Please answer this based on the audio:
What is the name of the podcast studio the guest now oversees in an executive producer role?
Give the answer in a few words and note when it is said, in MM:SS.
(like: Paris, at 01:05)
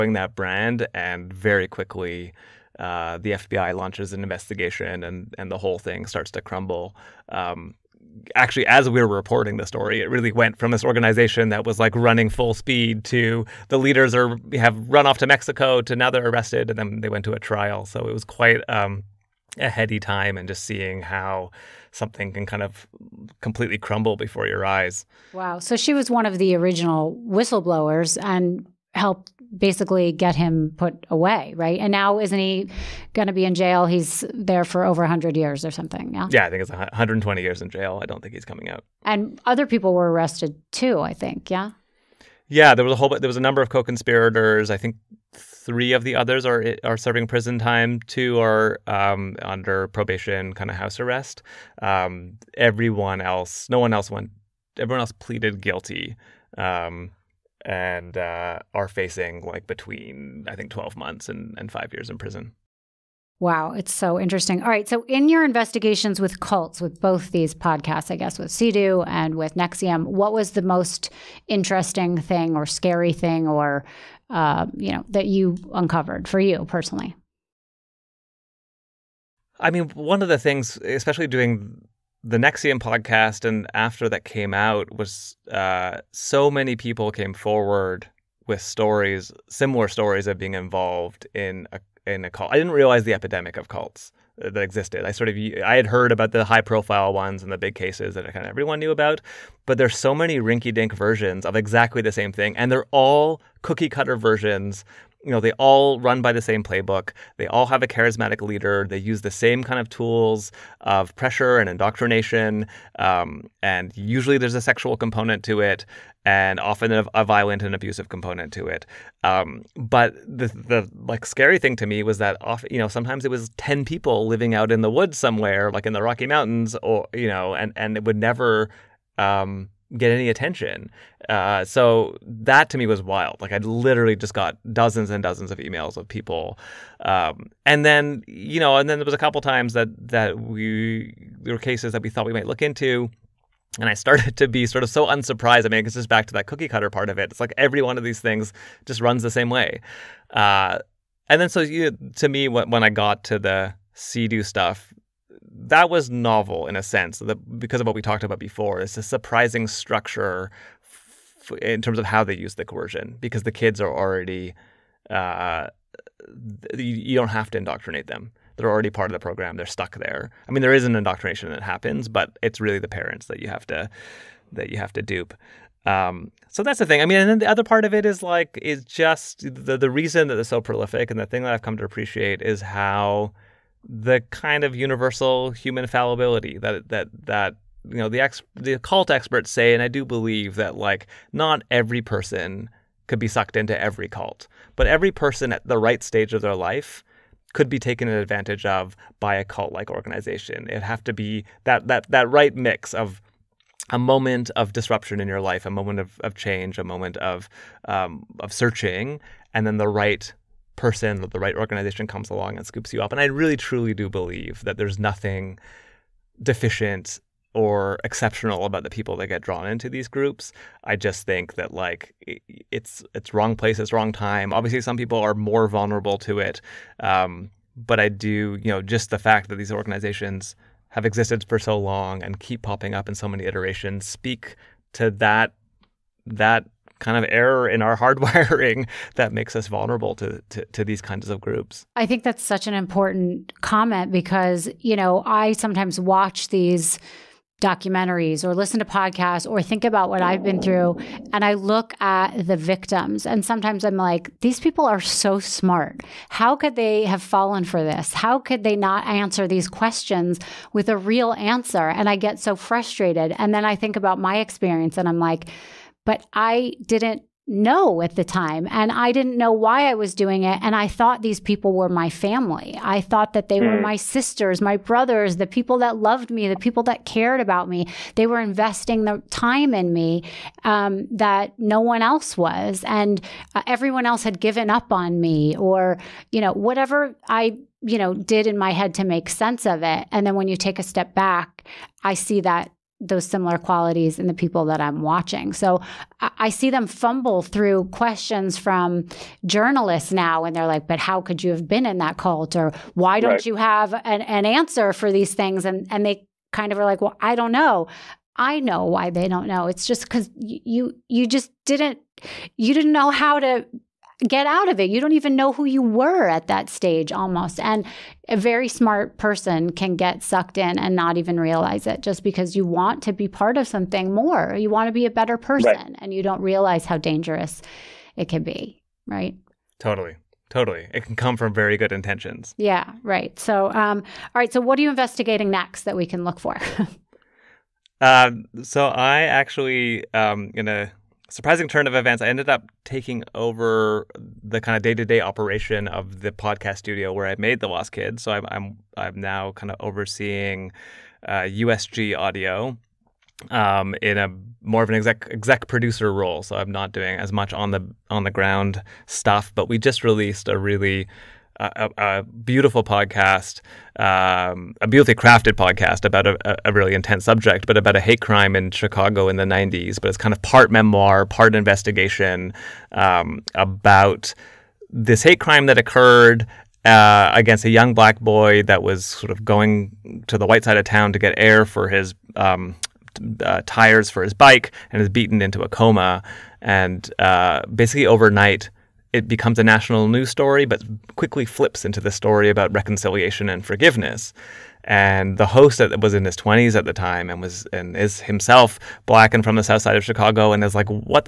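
USG Audio, at 05:51.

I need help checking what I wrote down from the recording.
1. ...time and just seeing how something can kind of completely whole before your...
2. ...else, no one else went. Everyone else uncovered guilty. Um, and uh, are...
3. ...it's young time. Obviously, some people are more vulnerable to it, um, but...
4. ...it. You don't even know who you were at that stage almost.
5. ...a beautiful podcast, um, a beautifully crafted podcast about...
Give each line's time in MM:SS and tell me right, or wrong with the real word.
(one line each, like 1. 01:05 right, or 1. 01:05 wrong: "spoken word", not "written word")
1. 00:19 wrong: "crumble", not "whole"
2. 00:53 wrong: "pleaded", not "uncovered"
3. 03:43 wrong: "wrong", not "young"
4. 05:14 right
5. 06:01 right.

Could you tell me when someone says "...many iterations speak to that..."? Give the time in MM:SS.
03:53.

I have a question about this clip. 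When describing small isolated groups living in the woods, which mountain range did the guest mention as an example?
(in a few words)
Rocky Mountains.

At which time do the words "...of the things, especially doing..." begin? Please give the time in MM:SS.
01:20.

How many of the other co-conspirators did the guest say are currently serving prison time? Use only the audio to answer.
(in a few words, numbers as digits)
3.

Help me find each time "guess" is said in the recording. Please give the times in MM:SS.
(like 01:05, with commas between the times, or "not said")
01:08.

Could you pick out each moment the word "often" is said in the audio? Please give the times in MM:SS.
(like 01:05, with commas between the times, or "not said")
01:56, 02:02.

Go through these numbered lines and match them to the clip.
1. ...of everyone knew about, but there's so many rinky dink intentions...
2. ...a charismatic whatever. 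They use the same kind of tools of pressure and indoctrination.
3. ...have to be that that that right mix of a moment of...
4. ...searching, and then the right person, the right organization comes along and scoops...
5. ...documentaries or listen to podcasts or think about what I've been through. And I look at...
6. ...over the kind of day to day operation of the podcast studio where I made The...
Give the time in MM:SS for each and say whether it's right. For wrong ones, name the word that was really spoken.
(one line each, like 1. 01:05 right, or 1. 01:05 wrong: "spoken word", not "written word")
1. 01:38 wrong: "versions", not "intentions"
2. 01:47 wrong: "leader", not "whatever"
3. 03:20 right
4. 03:28 right
5. 04:07 right
6. 05:43 right.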